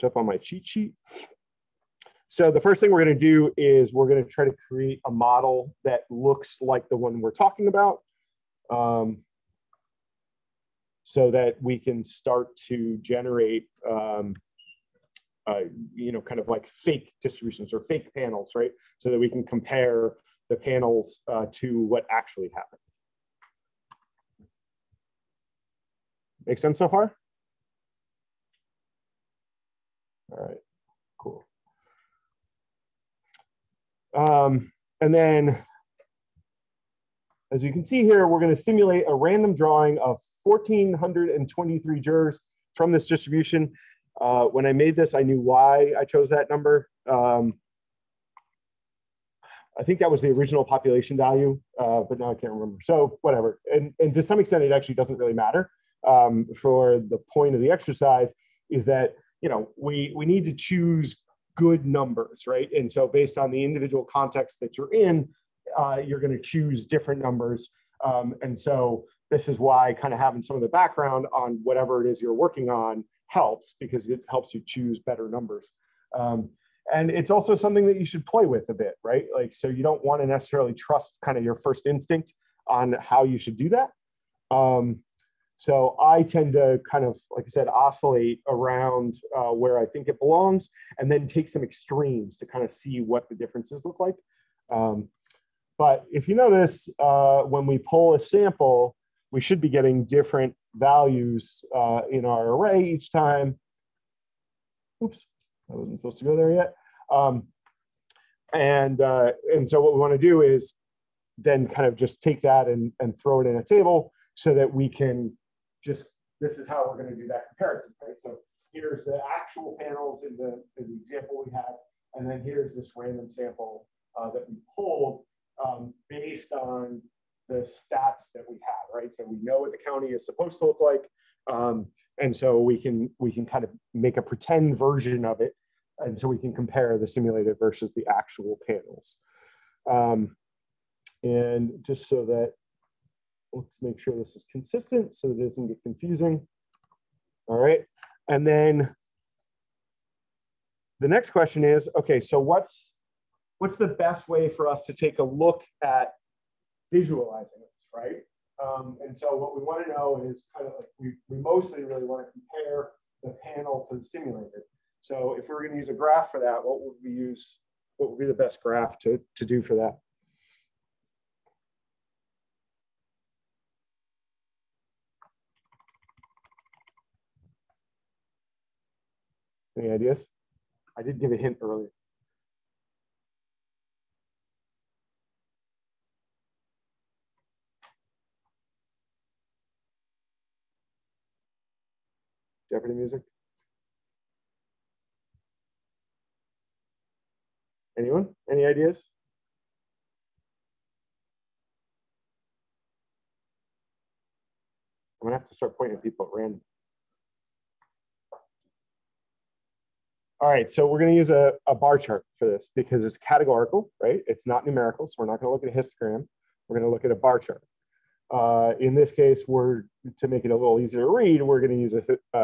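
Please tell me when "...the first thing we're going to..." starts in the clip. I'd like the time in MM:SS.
00:02.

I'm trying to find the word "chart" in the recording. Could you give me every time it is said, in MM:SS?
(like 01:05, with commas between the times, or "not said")
03:31, 03:37.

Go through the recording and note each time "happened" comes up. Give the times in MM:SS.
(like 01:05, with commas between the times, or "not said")
00:22.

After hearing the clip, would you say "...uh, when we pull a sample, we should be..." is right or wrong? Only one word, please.
right.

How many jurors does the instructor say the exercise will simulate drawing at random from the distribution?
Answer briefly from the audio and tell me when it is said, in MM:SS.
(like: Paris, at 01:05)
1,423, at 00:40.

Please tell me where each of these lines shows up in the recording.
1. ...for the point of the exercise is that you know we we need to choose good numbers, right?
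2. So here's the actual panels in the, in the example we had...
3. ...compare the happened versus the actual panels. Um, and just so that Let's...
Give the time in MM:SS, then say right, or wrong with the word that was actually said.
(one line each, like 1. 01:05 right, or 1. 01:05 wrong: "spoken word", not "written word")
1. 00:56 right
2. 01:58 right
3. 02:16 wrong: "simulated", not "happened".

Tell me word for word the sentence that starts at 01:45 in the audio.
Oops, I wasn't supposed to go there yet.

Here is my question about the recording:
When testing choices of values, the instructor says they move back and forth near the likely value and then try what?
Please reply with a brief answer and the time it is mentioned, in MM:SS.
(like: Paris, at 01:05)
some extremes, at 01:31.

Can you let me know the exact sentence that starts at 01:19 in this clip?
Like, so you don't want to necessarily trust kind of your first instinct on how you should do that.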